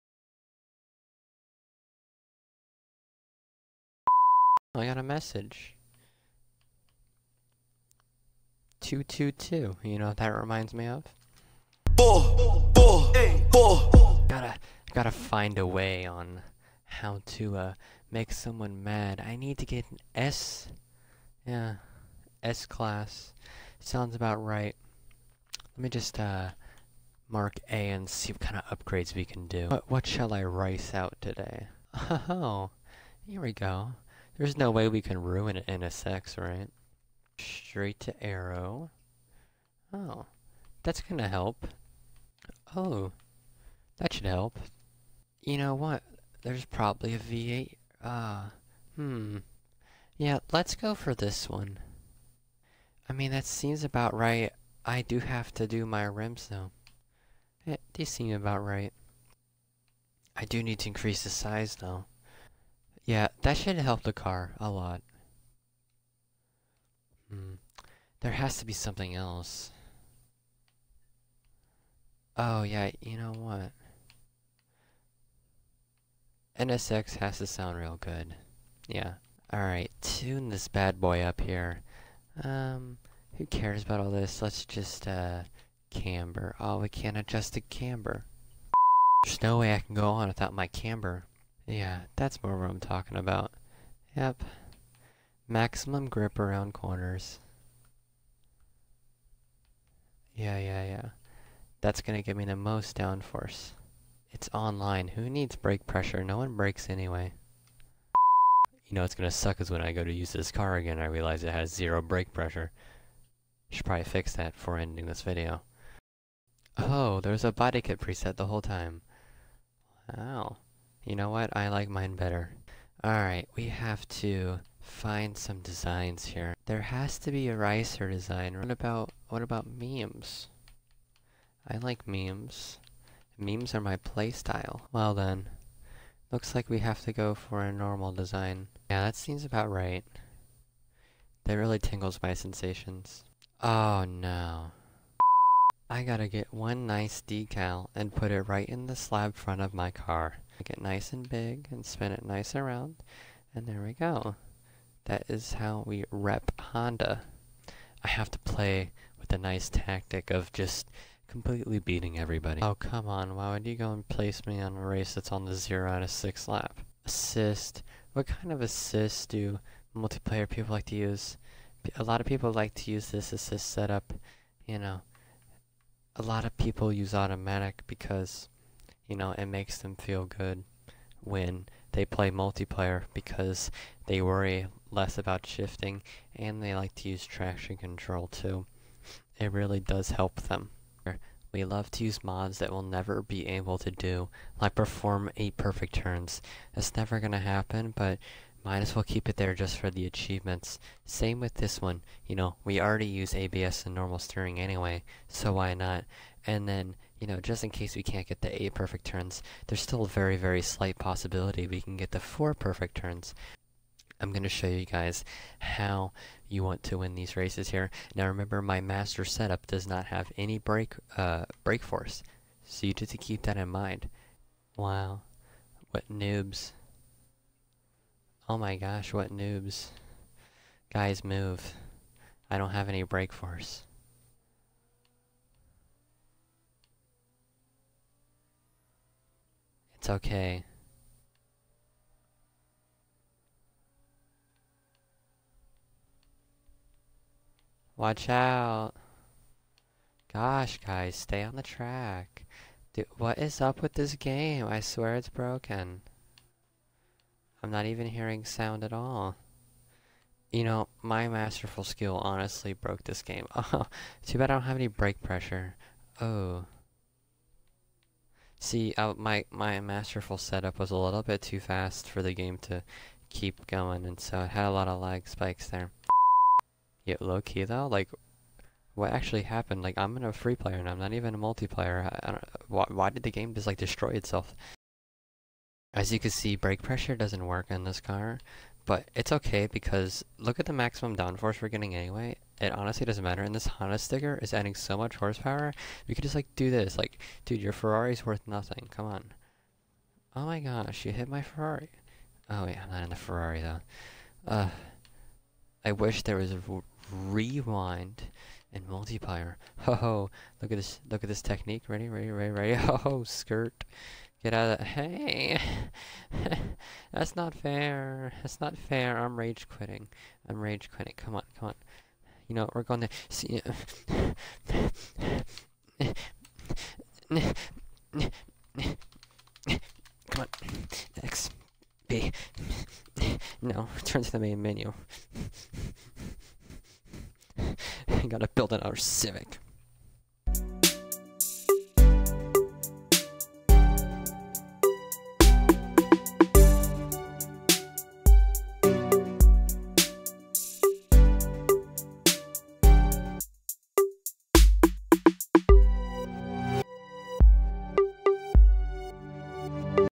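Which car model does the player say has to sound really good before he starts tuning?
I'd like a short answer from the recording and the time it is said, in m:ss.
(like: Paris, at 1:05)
NSX, at 1:16.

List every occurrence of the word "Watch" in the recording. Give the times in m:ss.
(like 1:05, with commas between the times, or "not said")
4:07.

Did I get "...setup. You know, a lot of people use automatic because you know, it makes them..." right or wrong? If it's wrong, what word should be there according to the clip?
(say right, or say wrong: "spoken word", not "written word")
right.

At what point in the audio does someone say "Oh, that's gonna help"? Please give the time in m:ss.
0:39.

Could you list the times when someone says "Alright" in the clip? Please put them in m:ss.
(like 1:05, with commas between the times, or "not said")
1:19, 2:03.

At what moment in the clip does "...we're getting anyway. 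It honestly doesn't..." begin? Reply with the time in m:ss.
4:51.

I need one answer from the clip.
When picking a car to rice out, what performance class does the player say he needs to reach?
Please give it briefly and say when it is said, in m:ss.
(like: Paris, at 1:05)
S class, at 0:22.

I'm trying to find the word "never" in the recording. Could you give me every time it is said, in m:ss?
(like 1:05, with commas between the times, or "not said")
3:12, 3:16.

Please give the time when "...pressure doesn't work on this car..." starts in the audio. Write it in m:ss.
4:46.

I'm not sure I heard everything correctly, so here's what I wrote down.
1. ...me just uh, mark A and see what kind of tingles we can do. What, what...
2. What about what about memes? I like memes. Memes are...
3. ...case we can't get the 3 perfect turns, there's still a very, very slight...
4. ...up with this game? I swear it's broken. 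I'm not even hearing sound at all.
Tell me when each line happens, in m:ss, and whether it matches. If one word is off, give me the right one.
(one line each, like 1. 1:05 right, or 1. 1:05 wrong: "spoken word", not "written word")
1. 0:25 wrong: "upgrades", not "tingles"
2. 2:08 right
3. 3:27 wrong: "8", not "3"
4. 4:13 right.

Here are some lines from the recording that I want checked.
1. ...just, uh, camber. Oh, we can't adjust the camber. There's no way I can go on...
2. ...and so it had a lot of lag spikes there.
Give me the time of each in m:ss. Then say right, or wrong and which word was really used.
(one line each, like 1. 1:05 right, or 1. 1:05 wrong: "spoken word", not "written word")
1. 1:24 right
2. 4:34 right.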